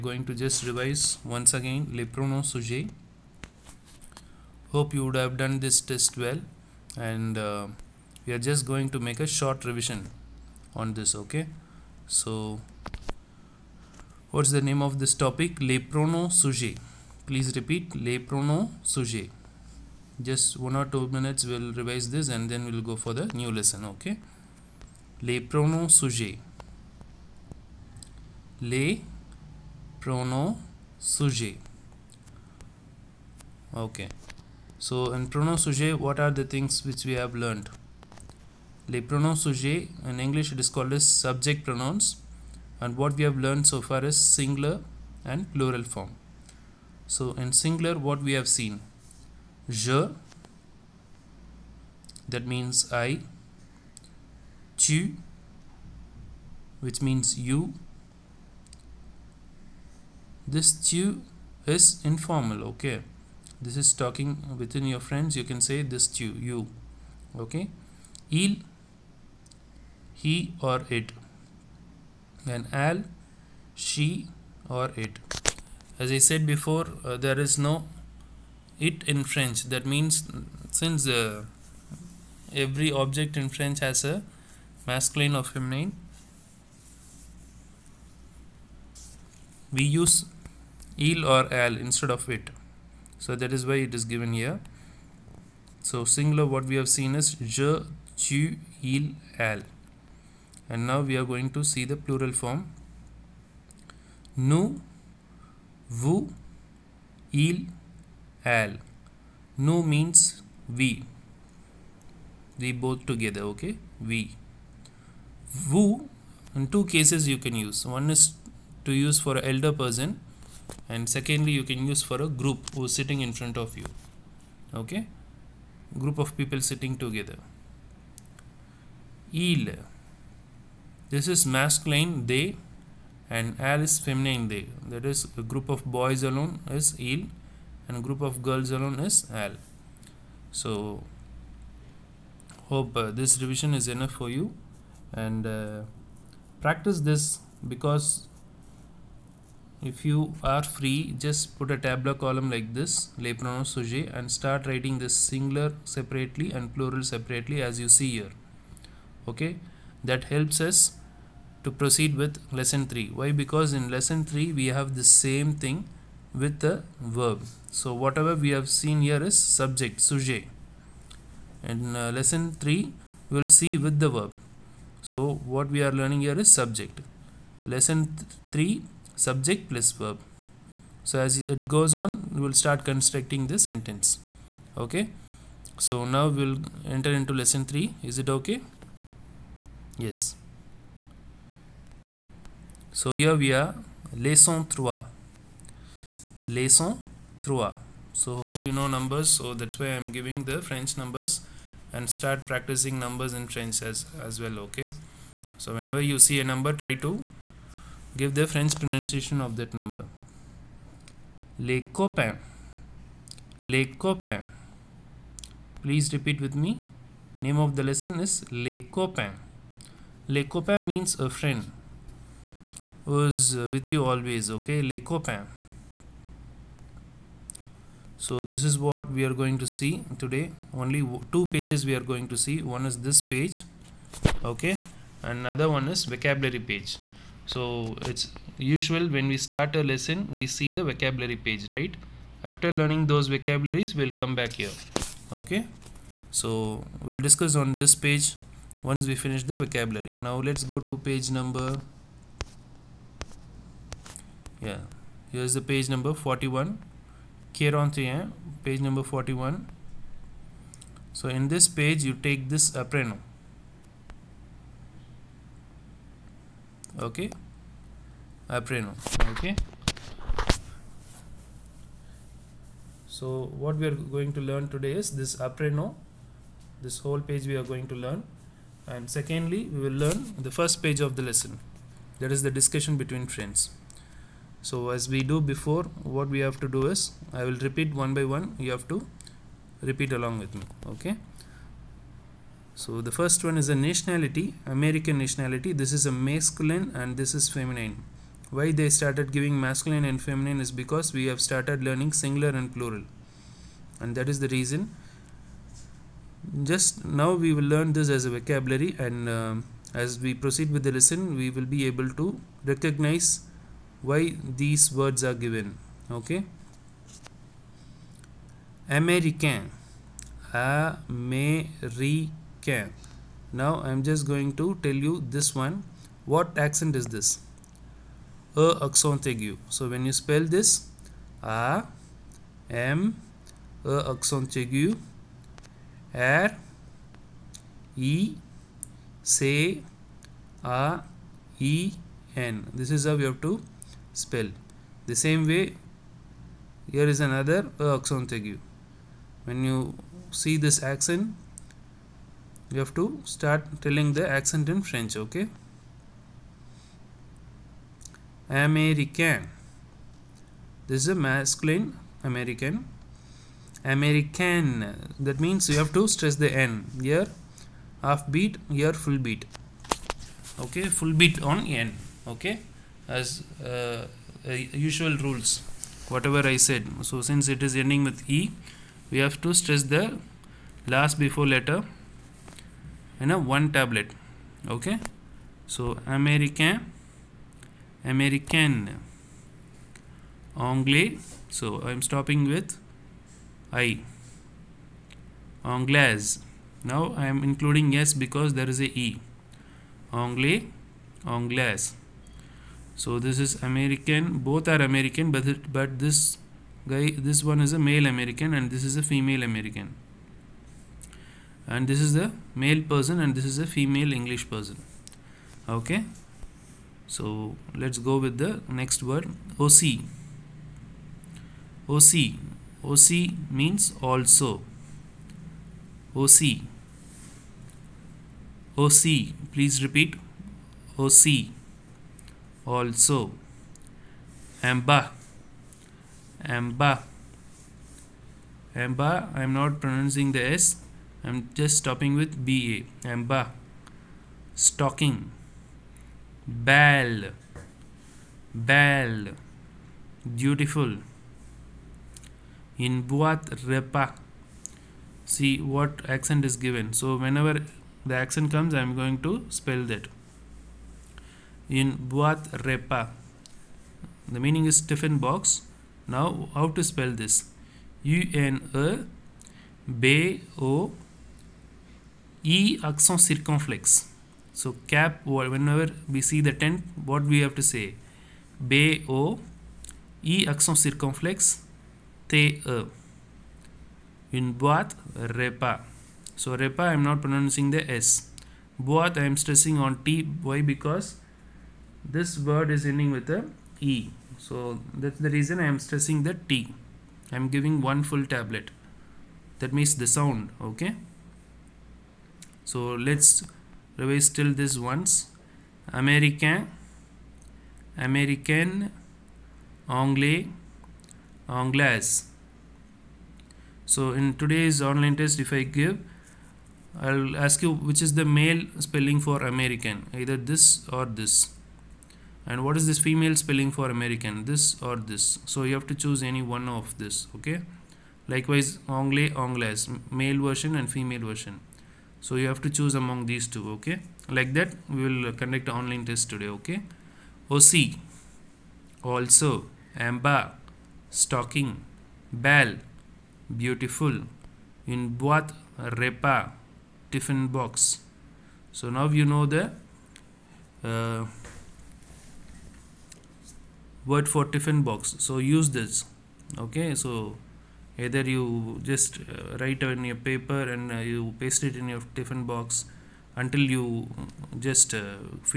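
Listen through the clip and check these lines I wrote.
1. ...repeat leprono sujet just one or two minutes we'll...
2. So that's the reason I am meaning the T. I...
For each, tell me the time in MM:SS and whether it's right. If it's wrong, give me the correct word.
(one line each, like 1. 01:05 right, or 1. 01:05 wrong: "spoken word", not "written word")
1. 00:17 right
2. 08:14 wrong: "stressing", not "meaning".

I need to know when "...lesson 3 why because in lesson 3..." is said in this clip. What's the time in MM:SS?
02:42.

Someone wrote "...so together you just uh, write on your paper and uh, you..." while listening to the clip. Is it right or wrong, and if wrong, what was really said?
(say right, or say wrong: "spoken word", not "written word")
wrong: "either", not "together".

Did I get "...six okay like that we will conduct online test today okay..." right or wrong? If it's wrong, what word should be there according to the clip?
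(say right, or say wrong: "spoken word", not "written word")
wrong: "two", not "six".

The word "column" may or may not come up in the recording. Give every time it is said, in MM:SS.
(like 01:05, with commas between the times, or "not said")
02:32.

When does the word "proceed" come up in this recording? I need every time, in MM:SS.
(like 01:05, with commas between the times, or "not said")
02:41, 05:10.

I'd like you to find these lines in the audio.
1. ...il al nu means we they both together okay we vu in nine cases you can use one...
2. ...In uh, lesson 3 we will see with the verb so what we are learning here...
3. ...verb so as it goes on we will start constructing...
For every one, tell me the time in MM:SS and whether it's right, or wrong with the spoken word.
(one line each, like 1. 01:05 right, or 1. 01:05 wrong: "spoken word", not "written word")
1. 01:47 wrong: "two", not "nine"
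2. 02:51 right
3. 03:00 right.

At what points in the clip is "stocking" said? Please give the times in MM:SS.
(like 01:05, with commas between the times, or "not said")
07:24, 09:01.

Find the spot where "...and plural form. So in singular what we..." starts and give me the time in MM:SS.
00:45.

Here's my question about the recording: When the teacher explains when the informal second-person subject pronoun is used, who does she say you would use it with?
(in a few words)
your friends.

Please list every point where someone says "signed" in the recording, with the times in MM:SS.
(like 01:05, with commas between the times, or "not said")
not said.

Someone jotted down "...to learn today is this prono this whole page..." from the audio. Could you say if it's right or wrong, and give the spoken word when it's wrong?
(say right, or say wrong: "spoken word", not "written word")
wrong: "apreno", not "prono".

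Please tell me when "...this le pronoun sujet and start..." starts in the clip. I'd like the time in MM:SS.
02:32.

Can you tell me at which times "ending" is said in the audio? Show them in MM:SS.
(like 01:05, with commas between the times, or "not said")
06:17, 08:12.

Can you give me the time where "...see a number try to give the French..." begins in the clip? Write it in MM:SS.
03:26.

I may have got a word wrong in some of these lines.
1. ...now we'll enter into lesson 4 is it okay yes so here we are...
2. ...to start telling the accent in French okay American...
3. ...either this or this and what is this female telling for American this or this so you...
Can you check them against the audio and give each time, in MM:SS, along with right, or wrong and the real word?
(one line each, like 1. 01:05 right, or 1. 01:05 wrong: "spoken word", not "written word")
1. 03:06 wrong: "3", not "4"
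2. 05:53 right
3. 08:40 wrong: "spelling", not "telling".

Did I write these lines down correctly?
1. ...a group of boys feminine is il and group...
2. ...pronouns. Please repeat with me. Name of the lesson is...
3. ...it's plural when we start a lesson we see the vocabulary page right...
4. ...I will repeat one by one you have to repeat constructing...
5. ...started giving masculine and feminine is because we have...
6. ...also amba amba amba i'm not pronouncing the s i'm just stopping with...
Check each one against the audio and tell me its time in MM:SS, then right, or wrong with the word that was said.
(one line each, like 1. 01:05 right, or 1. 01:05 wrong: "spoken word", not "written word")
1. 02:15 wrong: "alone", not "feminine"
2. 03:33 wrong: "copains", not "pronouns"
3. 03:58 wrong: "usual", not "plural"
4. 04:47 wrong: "along", not "constructing"
5. 04:58 right
6. 07:12 right.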